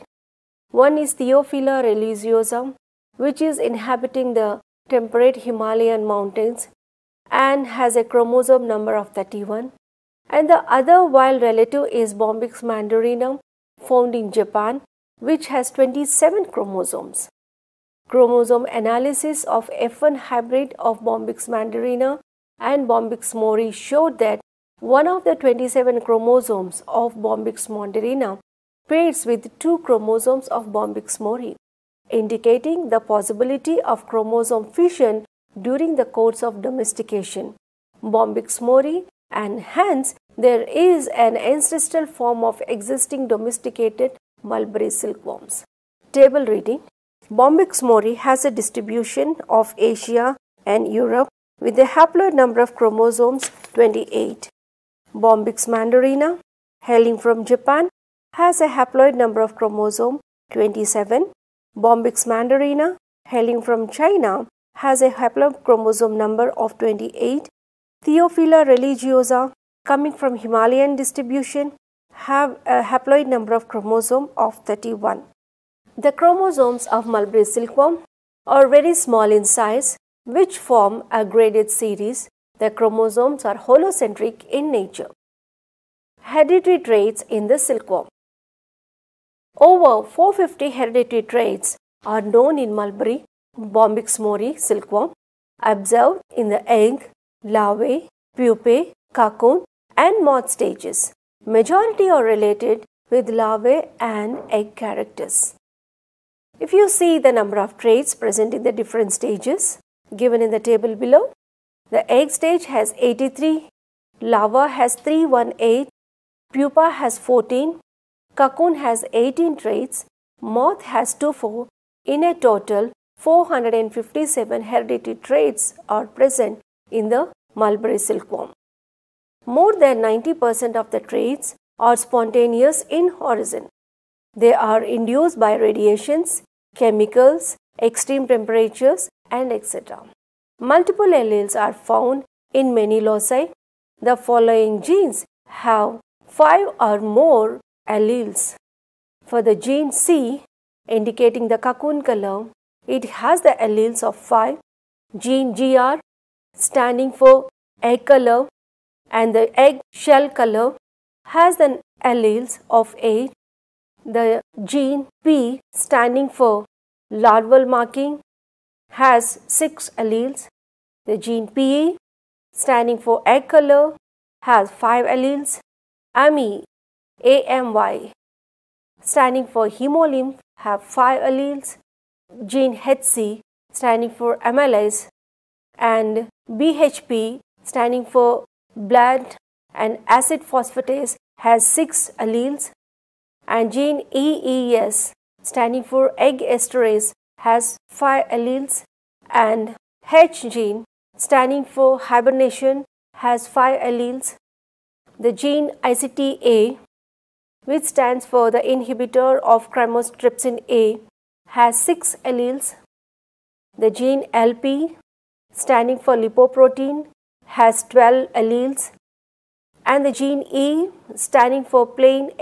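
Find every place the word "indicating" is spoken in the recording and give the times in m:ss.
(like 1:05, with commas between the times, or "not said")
0:32, 2:30.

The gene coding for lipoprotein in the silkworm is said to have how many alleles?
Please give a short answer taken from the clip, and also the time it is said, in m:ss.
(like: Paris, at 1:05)
12, at 3:37.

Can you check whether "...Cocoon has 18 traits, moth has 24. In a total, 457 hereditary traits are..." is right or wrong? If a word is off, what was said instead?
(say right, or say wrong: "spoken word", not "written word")
right.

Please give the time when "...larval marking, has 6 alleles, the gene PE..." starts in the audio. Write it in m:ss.
2:47.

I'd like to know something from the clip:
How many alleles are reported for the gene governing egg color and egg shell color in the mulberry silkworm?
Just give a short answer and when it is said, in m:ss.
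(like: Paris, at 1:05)
8, at 2:42.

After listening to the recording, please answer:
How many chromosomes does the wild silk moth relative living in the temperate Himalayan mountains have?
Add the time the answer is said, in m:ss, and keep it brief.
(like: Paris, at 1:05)
31, at 0:08.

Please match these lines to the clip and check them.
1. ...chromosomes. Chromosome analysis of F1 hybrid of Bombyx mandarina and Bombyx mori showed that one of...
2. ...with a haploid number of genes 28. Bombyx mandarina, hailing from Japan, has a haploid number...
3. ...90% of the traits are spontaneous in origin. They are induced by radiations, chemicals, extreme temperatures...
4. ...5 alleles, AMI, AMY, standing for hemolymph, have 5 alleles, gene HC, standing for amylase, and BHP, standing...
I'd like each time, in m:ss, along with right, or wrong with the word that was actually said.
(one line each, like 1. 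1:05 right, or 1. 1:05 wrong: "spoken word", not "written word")
1. 0:16 right
2. 0:51 wrong: "chromosomes", not "genes"
3. 2:09 right
4. 2:54 right.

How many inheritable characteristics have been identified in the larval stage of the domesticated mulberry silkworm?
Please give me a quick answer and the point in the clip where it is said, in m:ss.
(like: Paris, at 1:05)
318, at 1:54.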